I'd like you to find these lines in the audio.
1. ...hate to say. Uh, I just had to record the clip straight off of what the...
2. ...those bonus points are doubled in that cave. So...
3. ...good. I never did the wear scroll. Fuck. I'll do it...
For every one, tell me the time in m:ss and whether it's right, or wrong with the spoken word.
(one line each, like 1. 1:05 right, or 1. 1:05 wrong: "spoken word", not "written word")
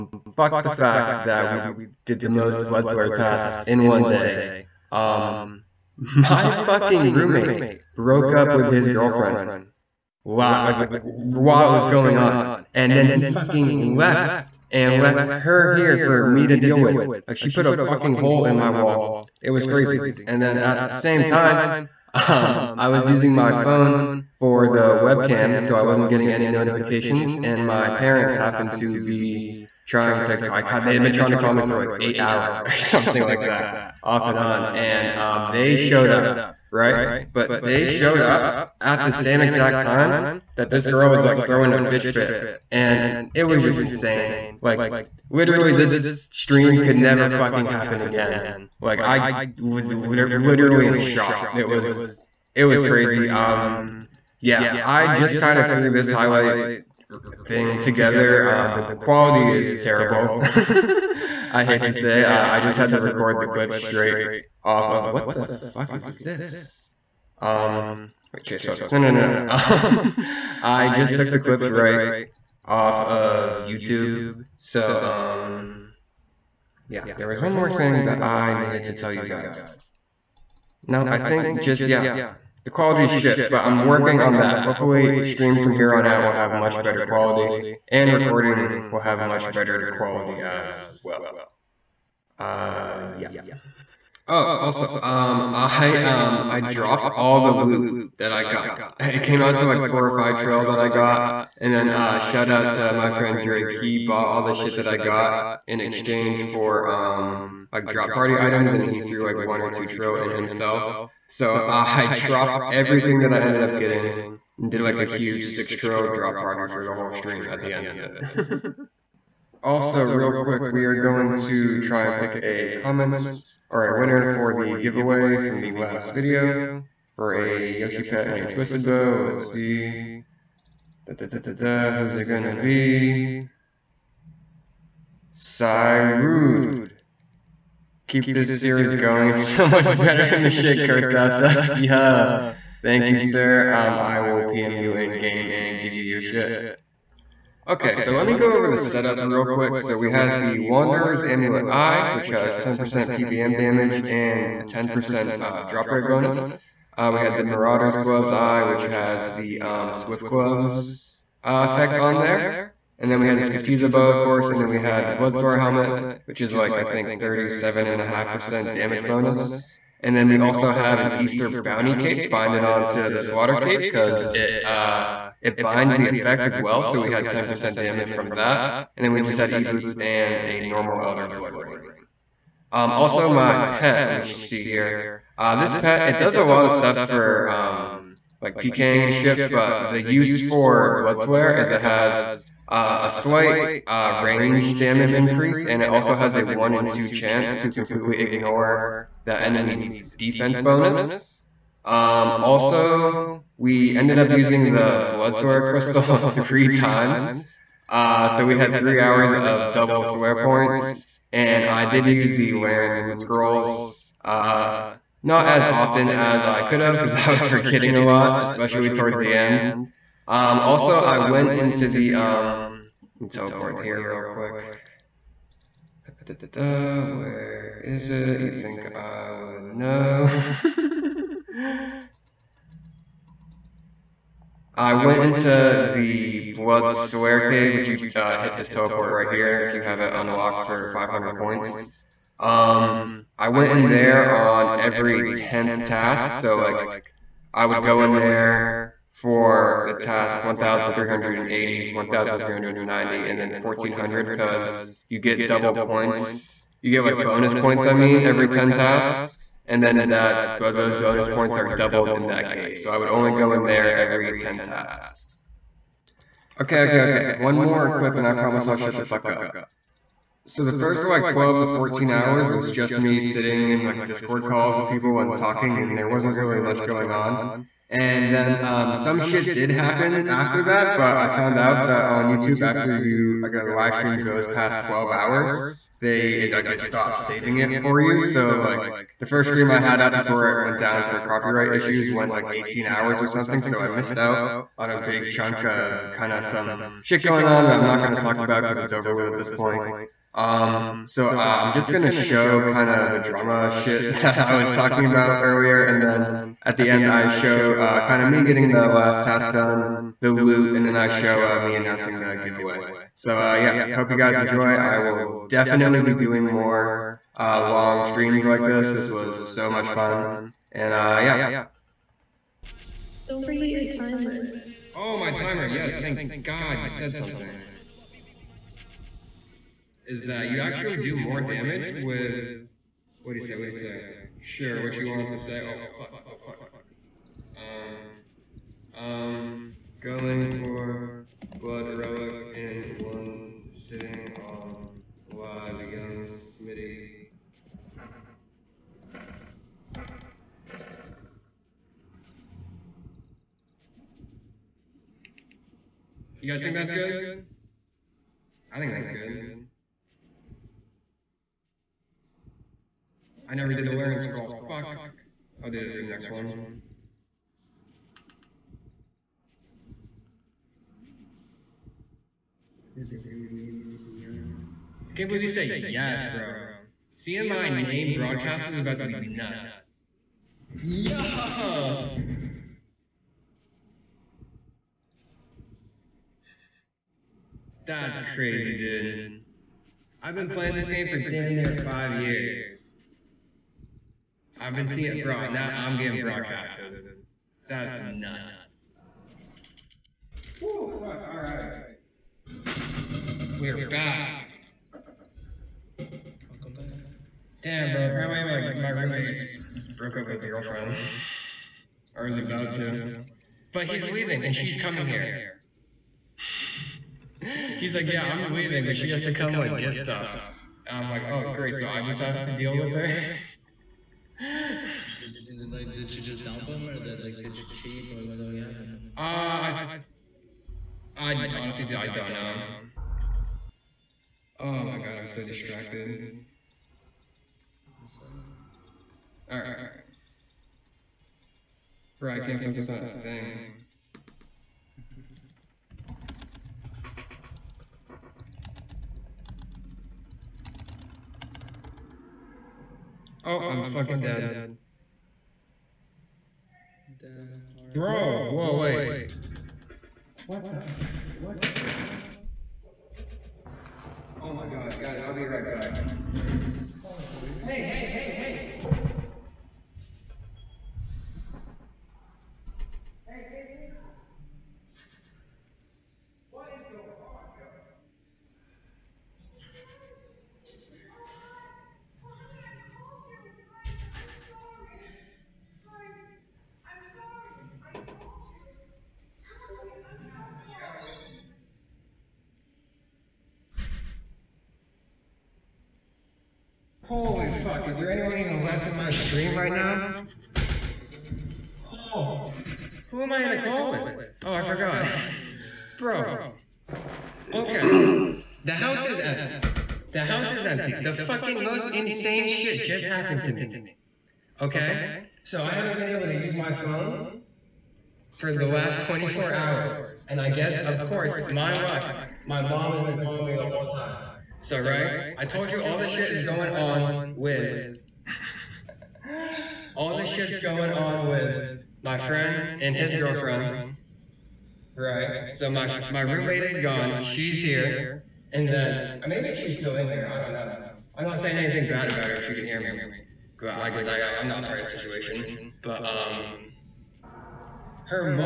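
1. 1:01 right
2. 4:20 right
3. 5:59 right.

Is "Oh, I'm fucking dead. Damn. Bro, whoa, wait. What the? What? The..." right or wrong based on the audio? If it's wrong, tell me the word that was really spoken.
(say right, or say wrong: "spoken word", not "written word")
right.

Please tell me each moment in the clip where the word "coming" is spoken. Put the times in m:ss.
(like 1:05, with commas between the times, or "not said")
6:54.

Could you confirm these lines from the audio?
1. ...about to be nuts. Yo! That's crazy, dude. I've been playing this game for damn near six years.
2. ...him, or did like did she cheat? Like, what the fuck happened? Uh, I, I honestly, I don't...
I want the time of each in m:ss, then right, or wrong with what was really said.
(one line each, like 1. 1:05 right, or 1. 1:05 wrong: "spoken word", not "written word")
1. 6:18 wrong: "five", not "six"
2. 7:06 right.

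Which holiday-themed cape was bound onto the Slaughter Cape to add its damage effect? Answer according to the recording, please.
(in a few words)
Easter Bounty Cape.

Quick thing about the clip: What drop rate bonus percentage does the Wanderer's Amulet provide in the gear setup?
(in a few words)
10%.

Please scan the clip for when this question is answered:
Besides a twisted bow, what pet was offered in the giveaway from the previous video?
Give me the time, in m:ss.
2:07.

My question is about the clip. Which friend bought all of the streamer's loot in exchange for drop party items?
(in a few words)
Drake.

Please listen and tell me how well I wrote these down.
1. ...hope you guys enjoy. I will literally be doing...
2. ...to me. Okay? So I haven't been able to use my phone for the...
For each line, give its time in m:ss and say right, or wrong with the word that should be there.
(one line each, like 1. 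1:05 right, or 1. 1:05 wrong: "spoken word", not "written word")
1. 5:13 wrong: "definitely", not "literally"
2. 8:33 right.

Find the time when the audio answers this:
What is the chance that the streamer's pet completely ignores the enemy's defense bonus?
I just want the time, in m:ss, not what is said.
3:16.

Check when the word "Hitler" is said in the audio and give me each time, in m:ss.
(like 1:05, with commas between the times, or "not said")
not said.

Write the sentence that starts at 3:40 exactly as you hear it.
Um, also, I went into the, um, teleport here real quick.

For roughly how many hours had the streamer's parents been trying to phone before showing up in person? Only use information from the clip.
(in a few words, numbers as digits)
8.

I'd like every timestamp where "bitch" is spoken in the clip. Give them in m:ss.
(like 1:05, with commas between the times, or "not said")
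0:41.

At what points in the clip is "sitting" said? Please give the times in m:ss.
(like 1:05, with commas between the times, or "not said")
4:33, 5:43.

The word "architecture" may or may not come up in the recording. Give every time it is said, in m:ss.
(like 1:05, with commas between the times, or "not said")
not said.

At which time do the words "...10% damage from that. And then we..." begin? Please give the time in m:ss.
2:57.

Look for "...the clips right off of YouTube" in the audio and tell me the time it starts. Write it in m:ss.
1:11.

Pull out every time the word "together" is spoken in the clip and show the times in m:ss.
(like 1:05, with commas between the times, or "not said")
0:57.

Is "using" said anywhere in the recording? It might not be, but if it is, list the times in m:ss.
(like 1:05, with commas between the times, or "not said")
0:23, 3:24.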